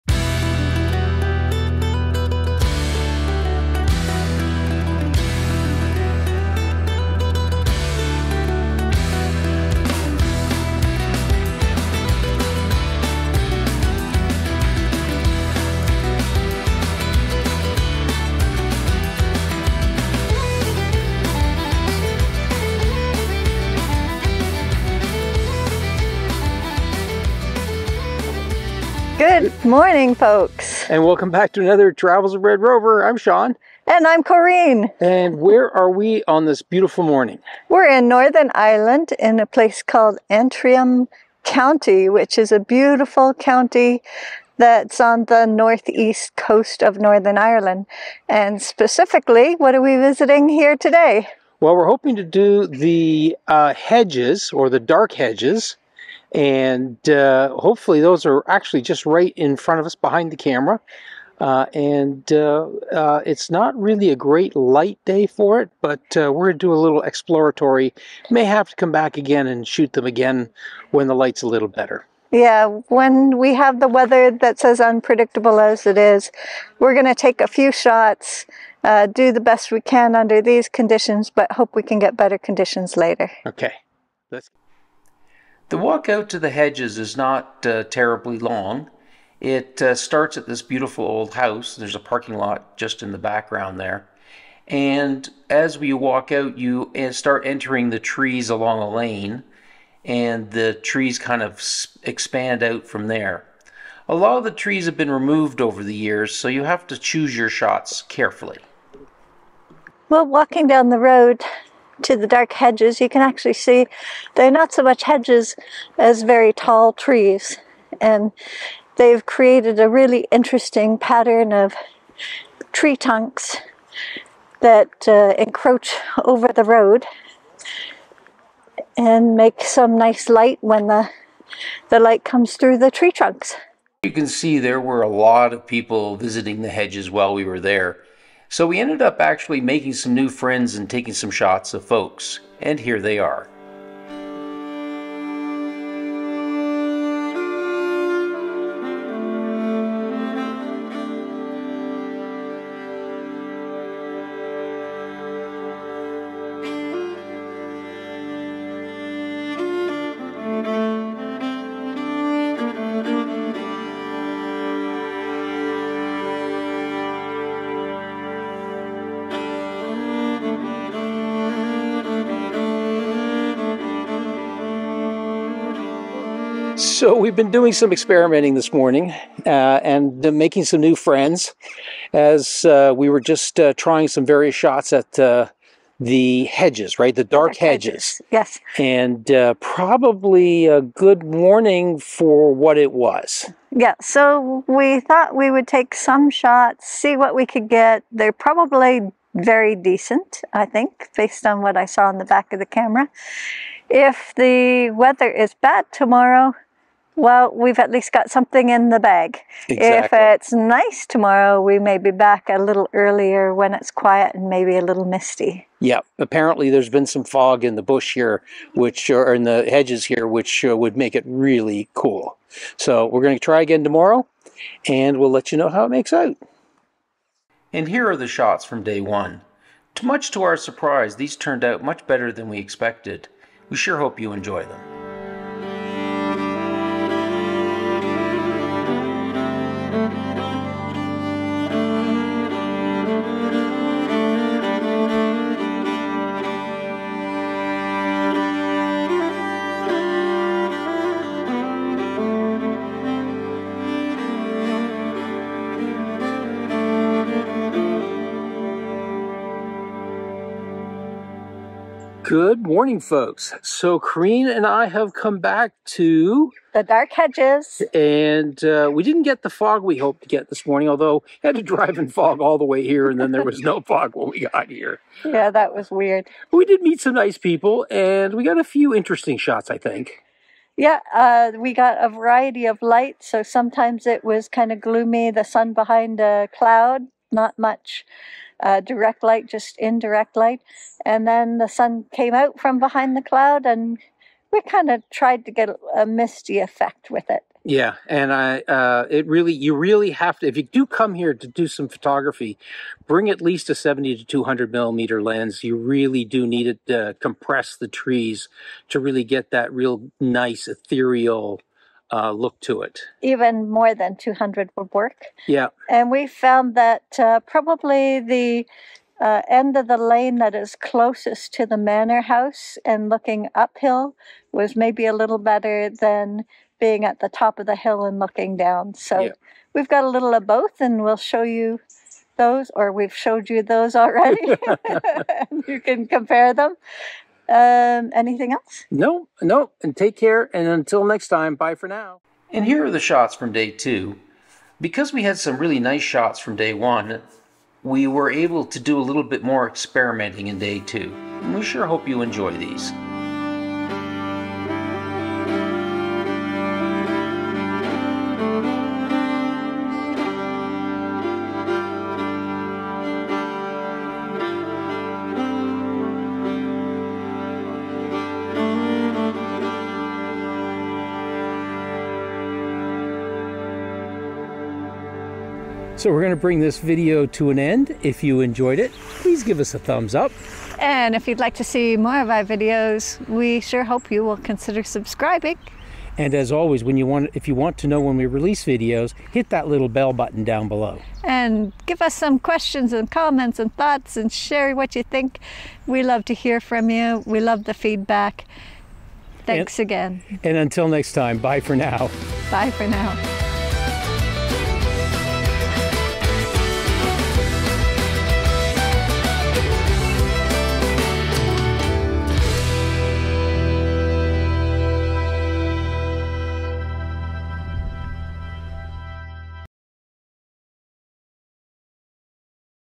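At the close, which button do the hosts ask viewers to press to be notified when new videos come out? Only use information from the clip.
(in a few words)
bell button.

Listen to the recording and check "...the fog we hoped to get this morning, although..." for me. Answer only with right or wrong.
right.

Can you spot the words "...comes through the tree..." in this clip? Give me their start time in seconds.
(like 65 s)
132 s.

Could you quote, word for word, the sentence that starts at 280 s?
Yeah, uh, we got a variety of light.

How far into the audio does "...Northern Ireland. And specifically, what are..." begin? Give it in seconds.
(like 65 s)
46 s.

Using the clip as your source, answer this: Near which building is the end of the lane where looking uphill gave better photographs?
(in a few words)
manor house.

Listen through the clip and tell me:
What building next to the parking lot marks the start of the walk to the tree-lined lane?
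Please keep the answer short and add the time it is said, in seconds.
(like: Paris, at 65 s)
old house, at 90 s.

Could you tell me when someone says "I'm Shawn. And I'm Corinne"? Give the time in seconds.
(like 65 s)
33 s.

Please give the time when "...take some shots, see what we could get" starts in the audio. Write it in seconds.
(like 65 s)
195 s.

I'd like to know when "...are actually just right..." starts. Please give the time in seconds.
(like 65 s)
58 s.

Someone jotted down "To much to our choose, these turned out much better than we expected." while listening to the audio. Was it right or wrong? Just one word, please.
wrong.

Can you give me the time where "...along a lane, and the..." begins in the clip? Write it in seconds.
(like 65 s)
98 s.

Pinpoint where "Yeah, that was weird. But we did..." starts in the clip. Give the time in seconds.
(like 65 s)
275 s.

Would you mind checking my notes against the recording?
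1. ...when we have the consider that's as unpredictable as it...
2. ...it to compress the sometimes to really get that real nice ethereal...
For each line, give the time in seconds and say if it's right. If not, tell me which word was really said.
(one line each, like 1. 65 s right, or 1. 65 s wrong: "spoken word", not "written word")
1. 72 s wrong: "weather", not "consider"
2. 306 s wrong: "trees", not "sometimes".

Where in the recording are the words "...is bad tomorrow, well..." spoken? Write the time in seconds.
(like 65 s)
205 s.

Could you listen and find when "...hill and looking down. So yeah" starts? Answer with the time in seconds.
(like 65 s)
327 s.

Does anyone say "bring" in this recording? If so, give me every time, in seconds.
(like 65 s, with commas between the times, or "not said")
303 s, 376 s.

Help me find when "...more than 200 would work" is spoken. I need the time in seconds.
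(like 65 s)
313 s.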